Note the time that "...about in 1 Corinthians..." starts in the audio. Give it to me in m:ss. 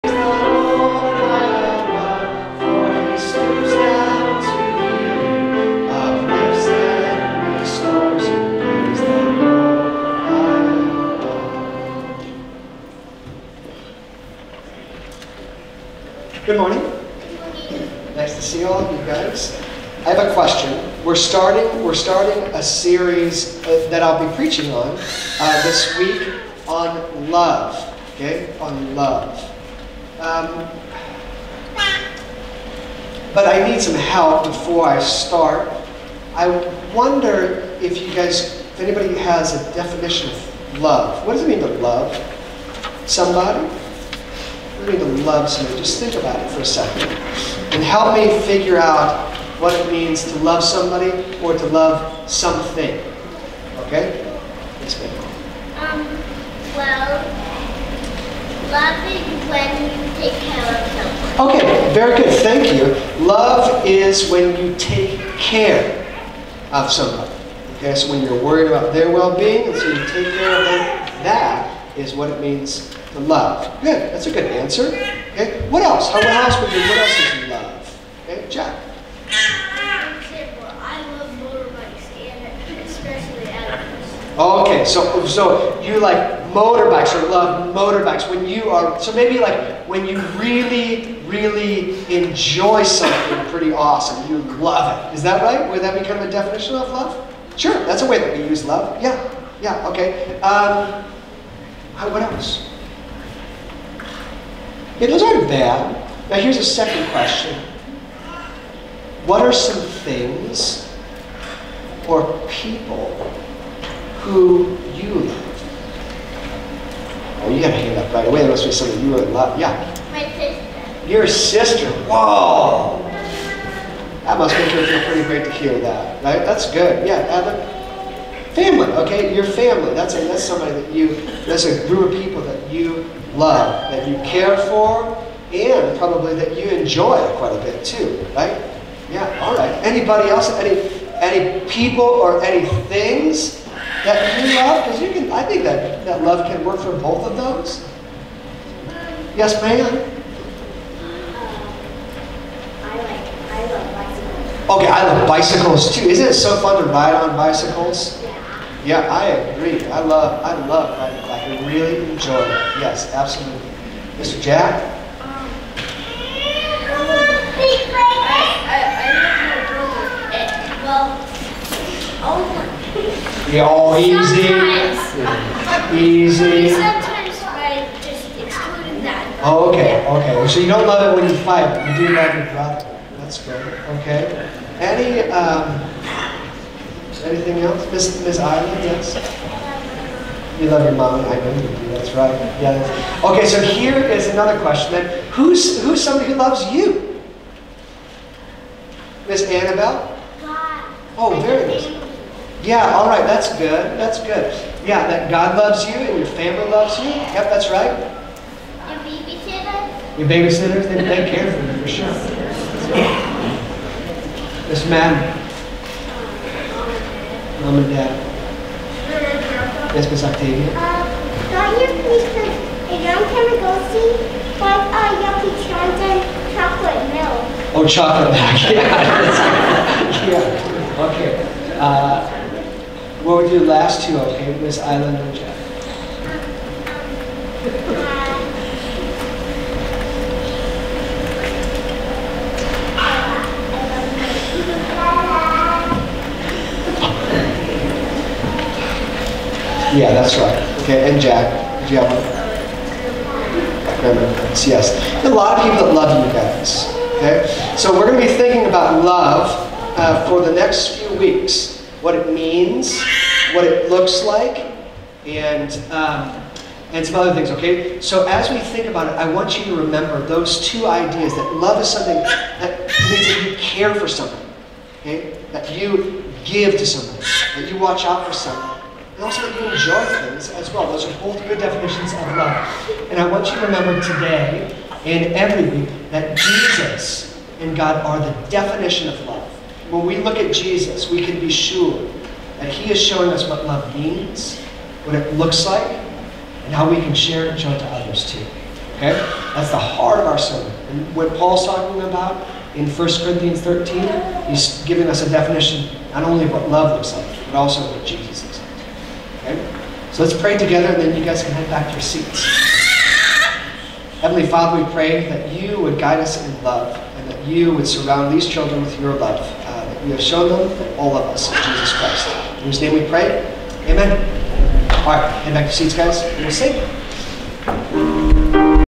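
5:02.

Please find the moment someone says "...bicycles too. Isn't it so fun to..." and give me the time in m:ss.
2:35.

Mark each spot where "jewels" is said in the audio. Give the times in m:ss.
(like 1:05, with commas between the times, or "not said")
not said.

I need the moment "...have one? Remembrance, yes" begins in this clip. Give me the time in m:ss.
4:11.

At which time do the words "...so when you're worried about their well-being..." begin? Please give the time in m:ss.
1:07.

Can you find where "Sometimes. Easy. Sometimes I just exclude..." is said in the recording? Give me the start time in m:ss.
2:54.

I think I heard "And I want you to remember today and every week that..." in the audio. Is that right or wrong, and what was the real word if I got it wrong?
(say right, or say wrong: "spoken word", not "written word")
right.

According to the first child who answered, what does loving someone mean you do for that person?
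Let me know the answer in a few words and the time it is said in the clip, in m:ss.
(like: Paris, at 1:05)
Take care of someone, at 1:00.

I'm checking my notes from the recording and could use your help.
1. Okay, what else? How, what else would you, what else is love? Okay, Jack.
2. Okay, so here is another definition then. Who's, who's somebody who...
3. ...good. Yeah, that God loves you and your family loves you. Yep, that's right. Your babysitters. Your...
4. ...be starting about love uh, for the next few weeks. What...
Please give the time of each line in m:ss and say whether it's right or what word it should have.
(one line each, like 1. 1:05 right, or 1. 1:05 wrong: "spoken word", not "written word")
1. 1:15 right
2. 3:13 wrong: "question", not "definition"
3. 3:24 right
4. 4:18 wrong: "thinking", not "starting".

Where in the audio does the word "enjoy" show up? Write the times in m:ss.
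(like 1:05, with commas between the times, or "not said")
1:32, 2:16, 2:42, 4:39.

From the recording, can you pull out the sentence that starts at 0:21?
We're starting, we're starting a series uh, that I'll be preaching on uh, this week on love.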